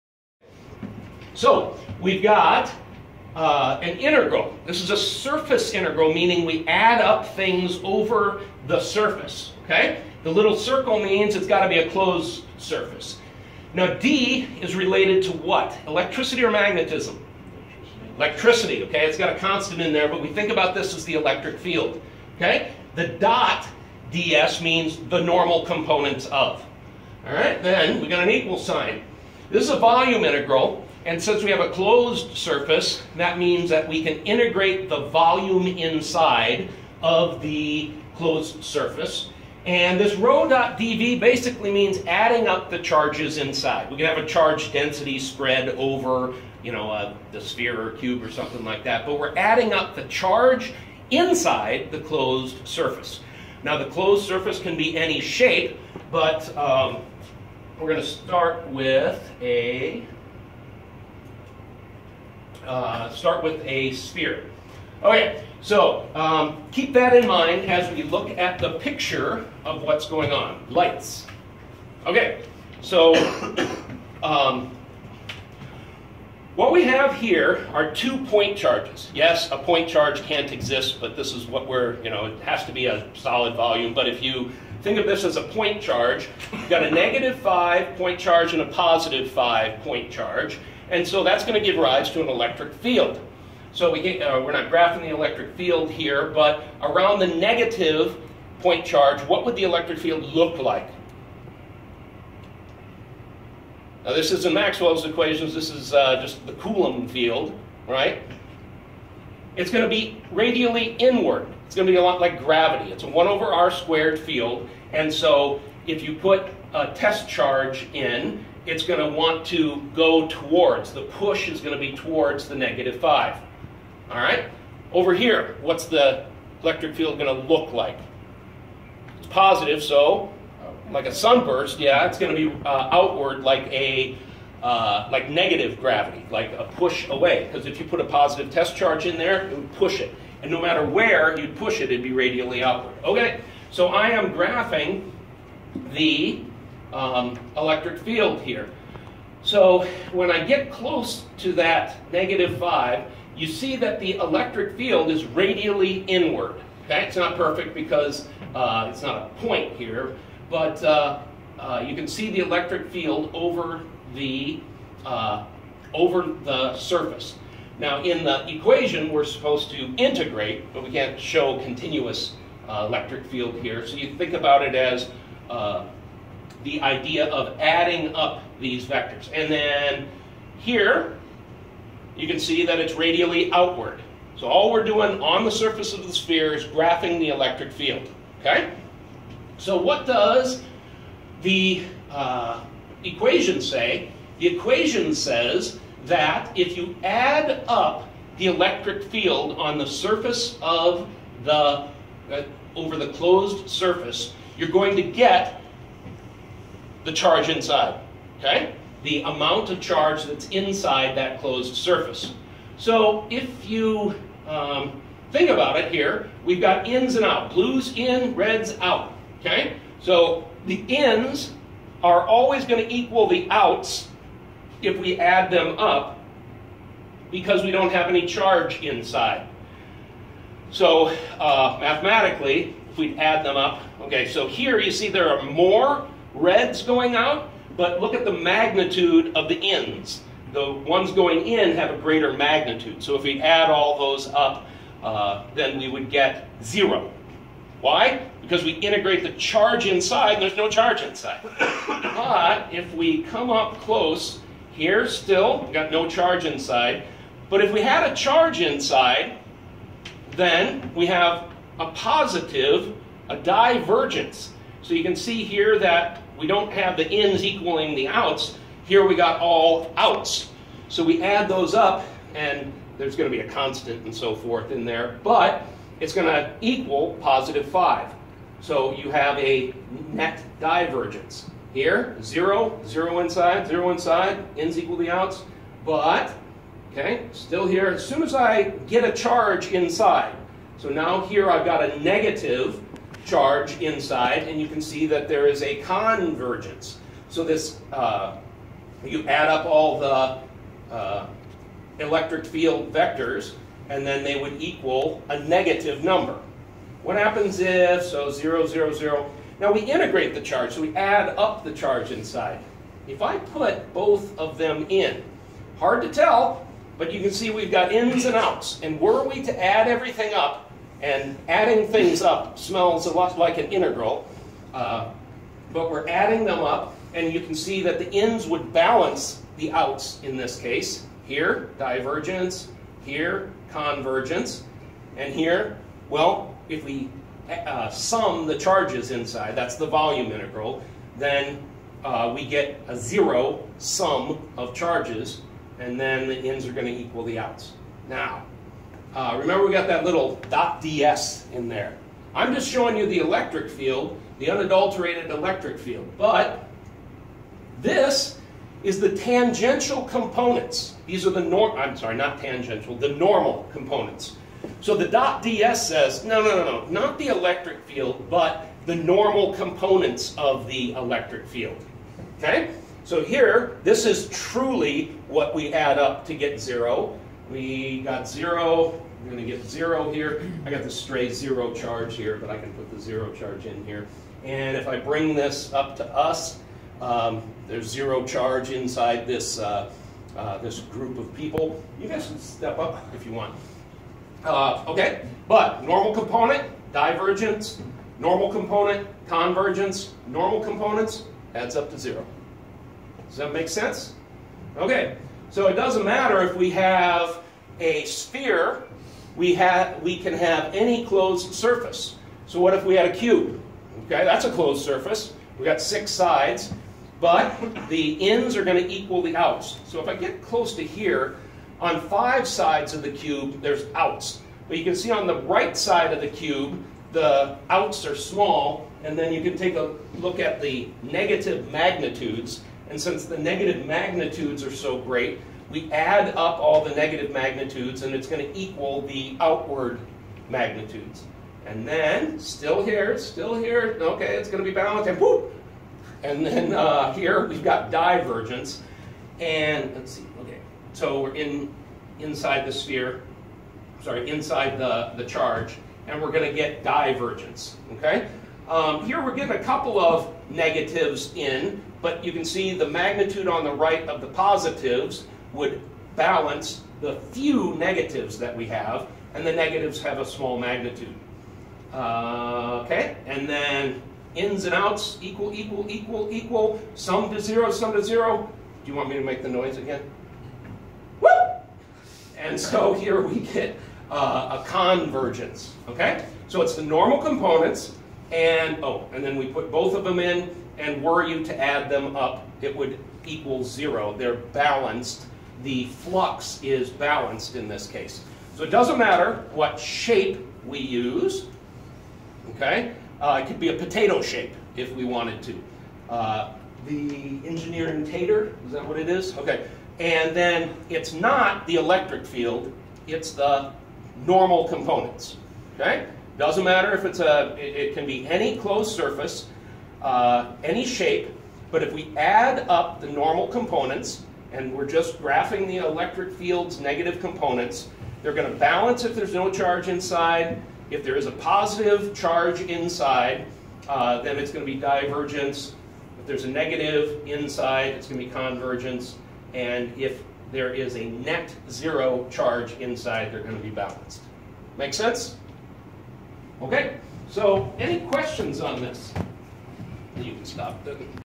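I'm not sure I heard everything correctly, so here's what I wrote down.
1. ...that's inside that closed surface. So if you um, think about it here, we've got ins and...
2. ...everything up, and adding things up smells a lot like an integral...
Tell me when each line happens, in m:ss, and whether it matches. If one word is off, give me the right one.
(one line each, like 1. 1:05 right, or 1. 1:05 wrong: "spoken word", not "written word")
1. 3:30 right
2. 5:19 right.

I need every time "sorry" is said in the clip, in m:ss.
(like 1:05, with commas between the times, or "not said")
6:01, 7:34.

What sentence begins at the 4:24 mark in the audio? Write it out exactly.
So you can see here that we don't have the ins equaling the outs.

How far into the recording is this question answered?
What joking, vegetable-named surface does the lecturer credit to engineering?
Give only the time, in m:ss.
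8:27.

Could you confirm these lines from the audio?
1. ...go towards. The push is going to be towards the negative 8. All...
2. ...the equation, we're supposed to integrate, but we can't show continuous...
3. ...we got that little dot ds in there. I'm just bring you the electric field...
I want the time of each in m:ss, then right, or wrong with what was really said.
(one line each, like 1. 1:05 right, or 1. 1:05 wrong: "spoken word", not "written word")
1. 1:59 wrong: "5", not "8"
2. 2:48 right
3. 5:49 wrong: "showing", not "bring".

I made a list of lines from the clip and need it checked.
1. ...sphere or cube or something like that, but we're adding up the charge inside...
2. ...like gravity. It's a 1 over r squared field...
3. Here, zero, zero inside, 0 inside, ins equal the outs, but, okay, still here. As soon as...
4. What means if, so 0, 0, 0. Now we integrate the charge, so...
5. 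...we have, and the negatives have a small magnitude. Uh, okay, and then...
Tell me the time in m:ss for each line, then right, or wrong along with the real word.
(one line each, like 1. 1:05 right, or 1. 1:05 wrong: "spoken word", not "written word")
1. 0:47 right
2. 1:52 right
3. 4:41 right
4. 5:07 wrong: "happens", not "means"
5. 7:48 right.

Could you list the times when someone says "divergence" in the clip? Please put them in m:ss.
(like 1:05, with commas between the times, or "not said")
4:23, 4:40, 5:31, 6:36, 7:27, 7:36, 8:54.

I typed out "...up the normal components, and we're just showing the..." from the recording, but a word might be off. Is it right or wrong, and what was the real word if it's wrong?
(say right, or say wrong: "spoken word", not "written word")
wrong: "graphing", not "showing".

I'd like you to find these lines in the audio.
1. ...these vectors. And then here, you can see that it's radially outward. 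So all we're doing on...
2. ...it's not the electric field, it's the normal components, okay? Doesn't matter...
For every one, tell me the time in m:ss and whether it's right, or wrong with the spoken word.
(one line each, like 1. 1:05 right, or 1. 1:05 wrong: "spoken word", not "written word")
1. 2:58 right
2. 8:30 right.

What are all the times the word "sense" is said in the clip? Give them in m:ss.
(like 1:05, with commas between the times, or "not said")
6:43, 9:04.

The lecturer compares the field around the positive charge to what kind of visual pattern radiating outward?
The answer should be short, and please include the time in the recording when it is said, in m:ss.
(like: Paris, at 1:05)
A sunburst, at 2:11.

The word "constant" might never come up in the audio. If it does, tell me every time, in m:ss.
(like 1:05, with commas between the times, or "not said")
0:19, 4:33.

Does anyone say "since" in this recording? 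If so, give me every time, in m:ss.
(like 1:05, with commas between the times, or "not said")
0:31, 7:12.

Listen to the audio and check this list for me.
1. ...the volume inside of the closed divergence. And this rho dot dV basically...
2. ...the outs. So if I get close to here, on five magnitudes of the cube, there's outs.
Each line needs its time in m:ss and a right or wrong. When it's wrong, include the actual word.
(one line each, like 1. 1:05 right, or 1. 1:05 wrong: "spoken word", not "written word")
1. 0:34 wrong: "surface", not "divergence"
2. 6:59 wrong: "sides", not "magnitudes".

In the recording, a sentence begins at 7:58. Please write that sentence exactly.
Do you want me to make the noise again?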